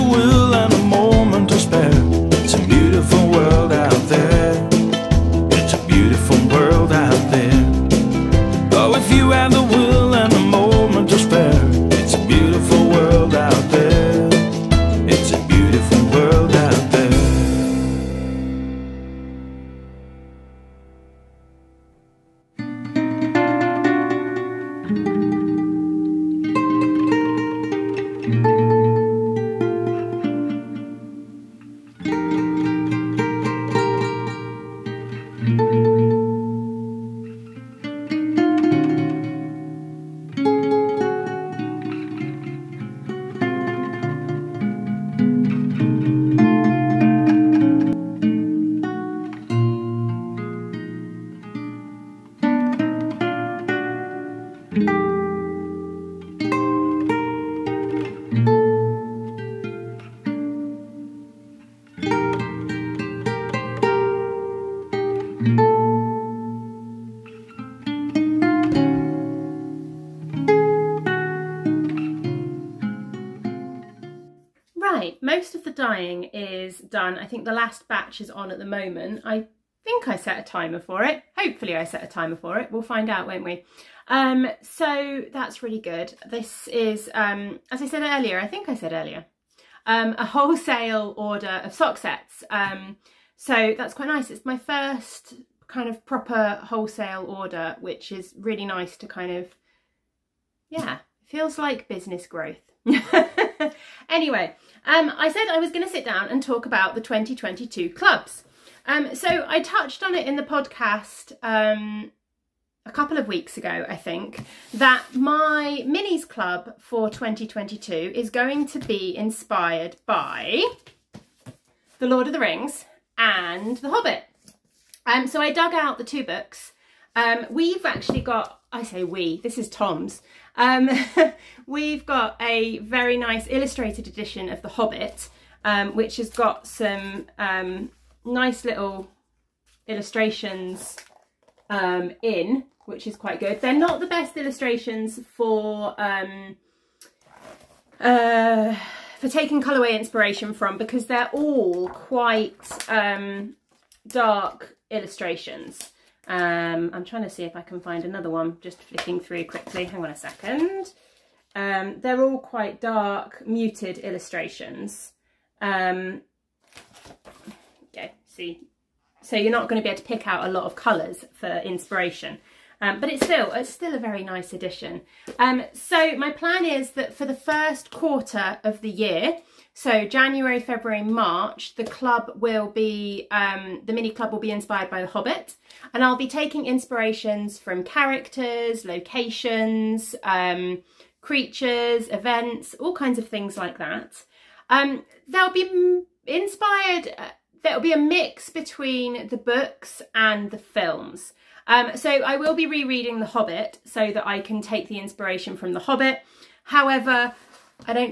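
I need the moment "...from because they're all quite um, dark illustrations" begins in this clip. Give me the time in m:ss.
2:30.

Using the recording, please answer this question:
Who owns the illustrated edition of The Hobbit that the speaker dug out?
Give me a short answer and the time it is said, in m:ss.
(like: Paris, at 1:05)
Tom, at 2:09.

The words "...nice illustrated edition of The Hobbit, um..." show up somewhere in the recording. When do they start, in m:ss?
2:13.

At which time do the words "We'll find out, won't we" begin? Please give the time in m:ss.
1:22.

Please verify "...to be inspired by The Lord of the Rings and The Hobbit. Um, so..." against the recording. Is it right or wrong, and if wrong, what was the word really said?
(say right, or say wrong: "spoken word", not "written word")
right.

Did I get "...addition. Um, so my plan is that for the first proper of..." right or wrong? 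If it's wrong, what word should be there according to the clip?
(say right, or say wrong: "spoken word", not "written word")
wrong: "quarter", not "proper".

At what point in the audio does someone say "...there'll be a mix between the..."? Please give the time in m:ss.
3:17.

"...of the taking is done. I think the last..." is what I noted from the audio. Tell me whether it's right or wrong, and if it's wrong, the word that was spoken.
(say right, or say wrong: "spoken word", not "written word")
wrong: "dyeing", not "taking".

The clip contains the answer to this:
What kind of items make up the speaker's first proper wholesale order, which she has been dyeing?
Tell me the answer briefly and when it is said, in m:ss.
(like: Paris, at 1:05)
Sock sets, at 1:31.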